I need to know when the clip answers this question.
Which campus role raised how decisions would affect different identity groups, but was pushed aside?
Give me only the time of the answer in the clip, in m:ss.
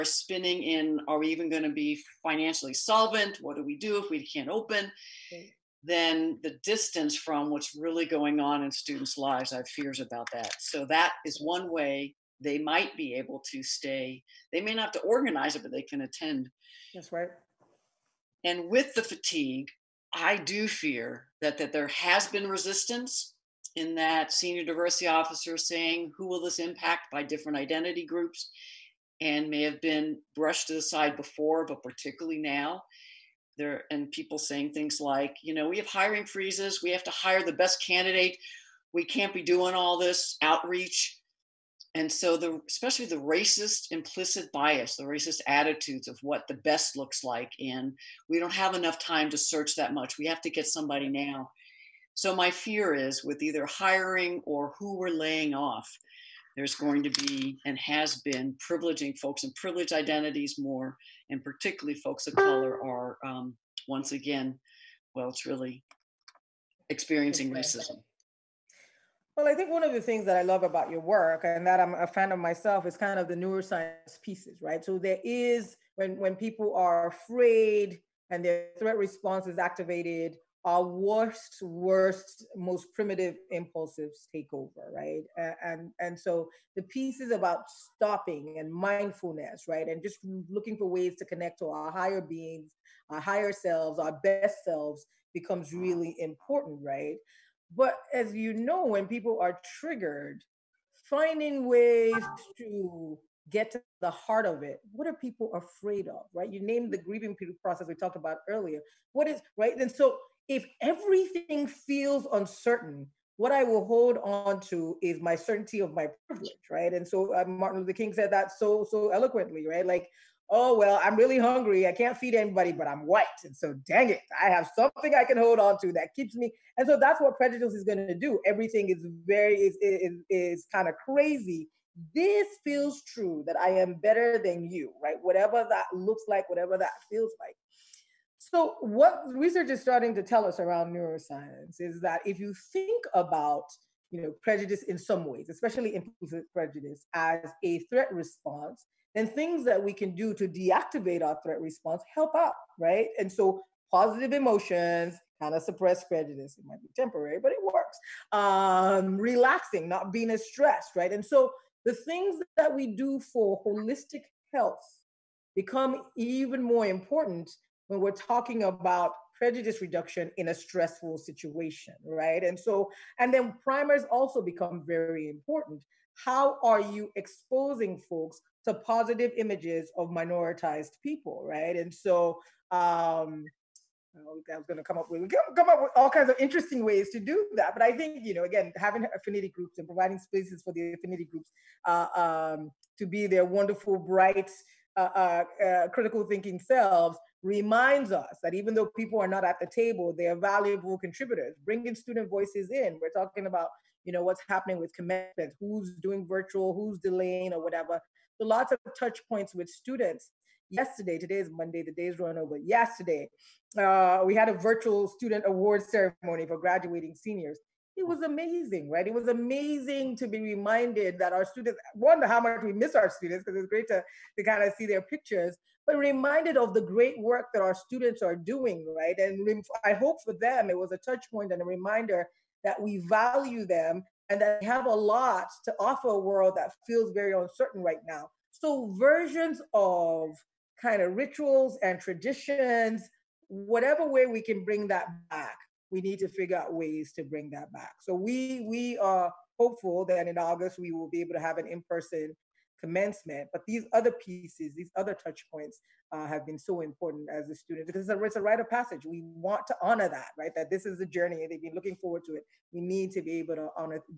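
0:24.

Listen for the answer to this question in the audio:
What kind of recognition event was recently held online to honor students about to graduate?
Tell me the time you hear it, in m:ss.
3:34.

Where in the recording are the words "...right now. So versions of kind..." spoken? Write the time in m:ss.
3:57.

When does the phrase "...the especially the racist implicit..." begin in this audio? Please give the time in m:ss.
0:42.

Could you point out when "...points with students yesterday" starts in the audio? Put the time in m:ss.
3:29.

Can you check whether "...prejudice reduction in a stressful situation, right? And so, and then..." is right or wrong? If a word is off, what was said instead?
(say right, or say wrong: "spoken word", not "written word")
right.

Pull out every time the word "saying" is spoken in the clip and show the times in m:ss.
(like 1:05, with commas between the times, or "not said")
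0:25, 0:34.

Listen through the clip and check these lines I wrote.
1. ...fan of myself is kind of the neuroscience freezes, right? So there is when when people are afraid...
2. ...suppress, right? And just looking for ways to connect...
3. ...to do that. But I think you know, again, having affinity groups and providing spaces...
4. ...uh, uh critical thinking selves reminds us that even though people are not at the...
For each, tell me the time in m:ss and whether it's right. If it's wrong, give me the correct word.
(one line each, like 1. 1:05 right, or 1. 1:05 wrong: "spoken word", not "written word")
1. 1:12 wrong: "pieces", not "freezes"
2. 1:28 wrong: "mindfulness", not "suppress"
3. 3:07 right
4. 3:15 right.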